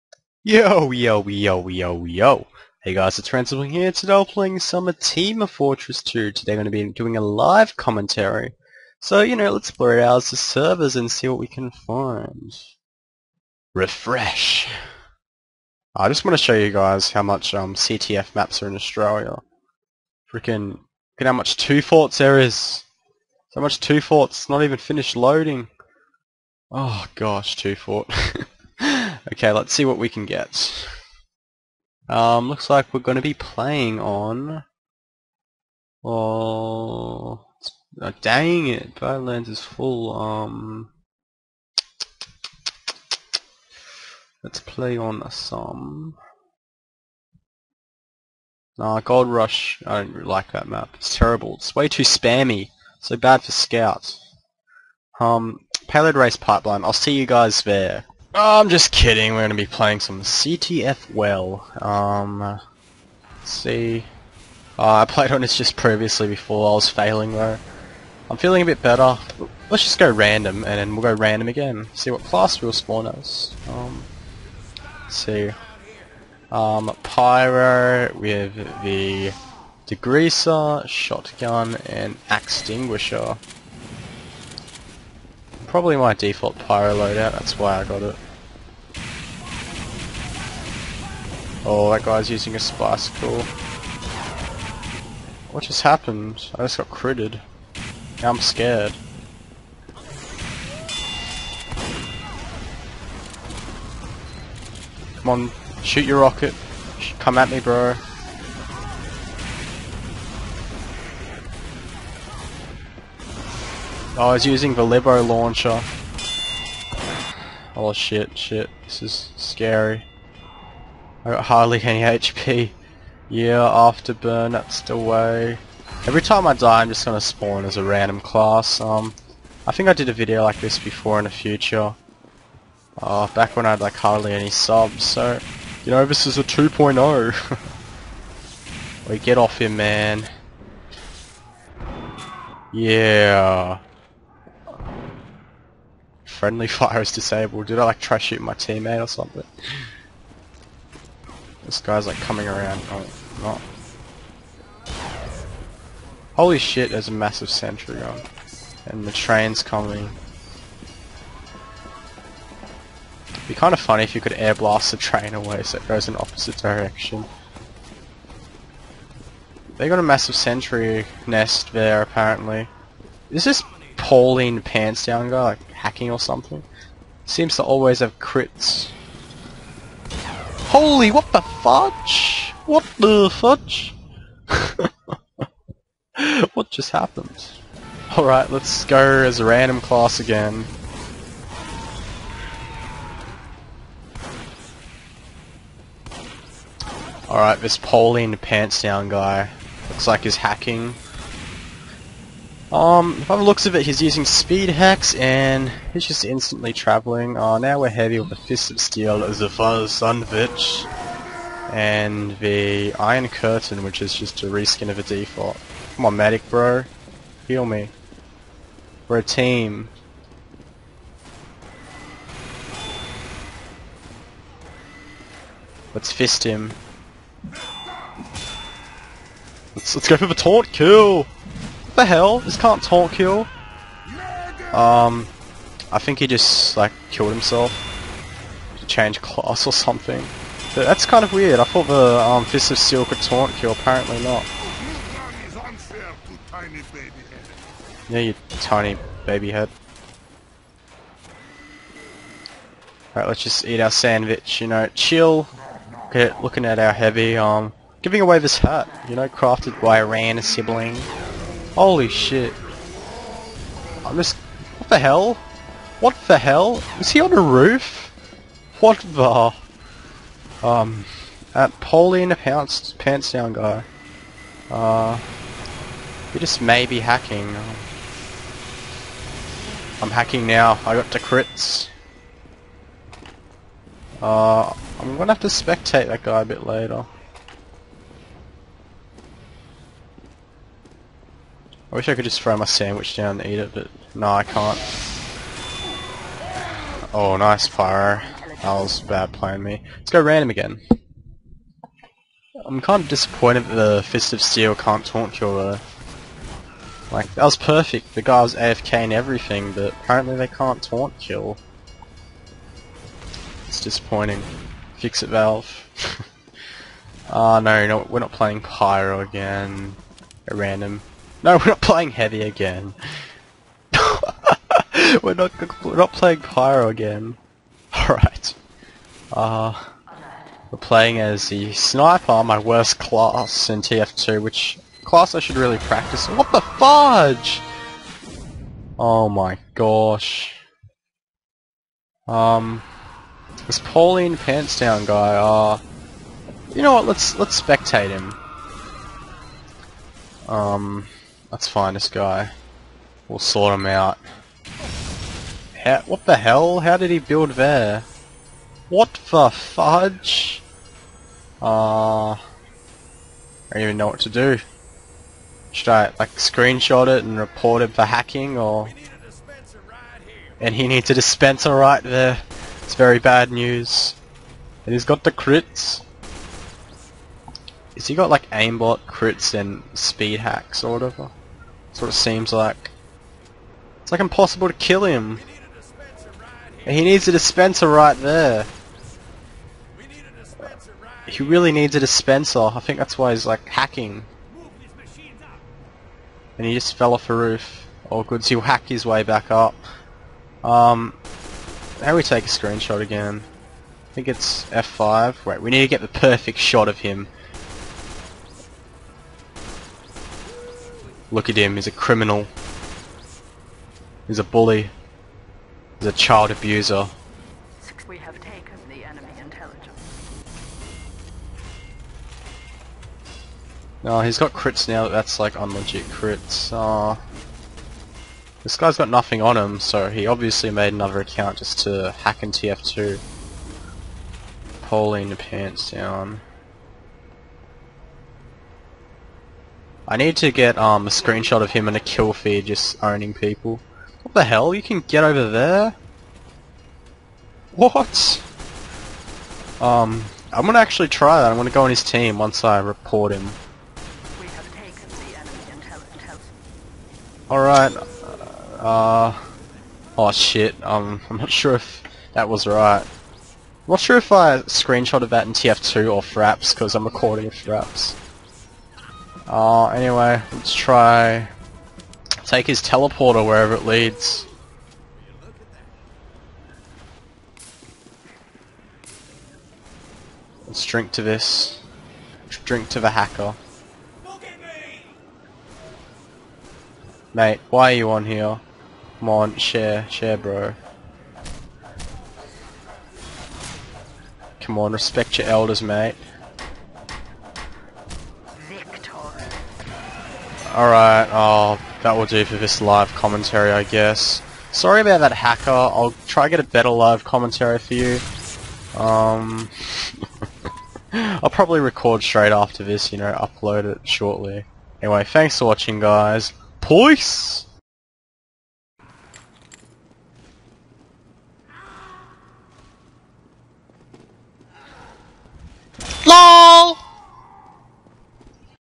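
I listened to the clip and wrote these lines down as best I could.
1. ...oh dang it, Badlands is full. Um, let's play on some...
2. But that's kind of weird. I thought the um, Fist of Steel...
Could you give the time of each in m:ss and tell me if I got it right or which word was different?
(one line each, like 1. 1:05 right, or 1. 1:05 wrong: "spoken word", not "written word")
1. 0:38 right
2. 4:00 right.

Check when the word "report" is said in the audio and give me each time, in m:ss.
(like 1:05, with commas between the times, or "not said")
6:07, 7:32.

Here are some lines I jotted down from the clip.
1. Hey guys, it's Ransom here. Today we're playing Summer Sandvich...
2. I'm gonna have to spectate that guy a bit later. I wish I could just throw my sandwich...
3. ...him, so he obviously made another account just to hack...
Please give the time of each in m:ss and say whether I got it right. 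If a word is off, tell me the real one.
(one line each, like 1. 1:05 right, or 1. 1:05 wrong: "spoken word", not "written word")
1. 0:02 wrong: "Team", not "Sandvich"
2. 4:44 right
3. 7:09 right.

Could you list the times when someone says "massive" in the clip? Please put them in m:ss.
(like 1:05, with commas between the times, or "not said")
2:37, 2:50.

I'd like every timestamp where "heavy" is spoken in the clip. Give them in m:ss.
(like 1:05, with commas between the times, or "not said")
3:27, 4:16, 5:22.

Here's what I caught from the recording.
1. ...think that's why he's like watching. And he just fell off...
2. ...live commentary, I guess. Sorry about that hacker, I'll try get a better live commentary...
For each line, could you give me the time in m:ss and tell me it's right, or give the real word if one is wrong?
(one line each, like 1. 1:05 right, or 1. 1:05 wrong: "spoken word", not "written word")
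1. 6:32 wrong: "hacking", not "watching"
2. 8:22 right.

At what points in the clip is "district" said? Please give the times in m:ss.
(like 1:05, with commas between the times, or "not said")
not said.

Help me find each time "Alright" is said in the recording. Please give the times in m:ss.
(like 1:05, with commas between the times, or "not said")
3:08, 3:17, 4:13, 7:37, 8:20.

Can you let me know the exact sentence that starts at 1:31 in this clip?
Oh, that guy's using a spice cool.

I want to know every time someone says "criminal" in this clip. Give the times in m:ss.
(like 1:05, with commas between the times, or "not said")
6:51.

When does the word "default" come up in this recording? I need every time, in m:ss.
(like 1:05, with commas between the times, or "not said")
1:26, 3:35.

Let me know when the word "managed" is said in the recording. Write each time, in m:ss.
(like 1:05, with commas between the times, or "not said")
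not said.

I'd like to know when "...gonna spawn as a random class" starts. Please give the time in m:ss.
2:07.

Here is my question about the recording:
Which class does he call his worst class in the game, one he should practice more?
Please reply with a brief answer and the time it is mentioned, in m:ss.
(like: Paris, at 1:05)
Sniper, at 5:31.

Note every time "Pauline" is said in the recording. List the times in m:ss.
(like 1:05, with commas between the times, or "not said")
2:53, 3:17, 4:31, 5:43.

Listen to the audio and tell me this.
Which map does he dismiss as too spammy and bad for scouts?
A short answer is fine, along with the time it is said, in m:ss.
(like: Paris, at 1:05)
Gold Rush, at 0:49.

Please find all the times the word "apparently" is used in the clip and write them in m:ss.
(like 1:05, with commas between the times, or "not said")
2:52, 4:03, 5:09.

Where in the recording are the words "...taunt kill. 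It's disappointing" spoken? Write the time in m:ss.
5:10.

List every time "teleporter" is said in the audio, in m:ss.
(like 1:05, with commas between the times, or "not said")
7:52.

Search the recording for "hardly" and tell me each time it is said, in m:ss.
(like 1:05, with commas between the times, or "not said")
2:01, 2:13.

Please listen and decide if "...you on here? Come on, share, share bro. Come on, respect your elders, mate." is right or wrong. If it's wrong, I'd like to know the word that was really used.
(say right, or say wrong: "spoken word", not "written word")
right.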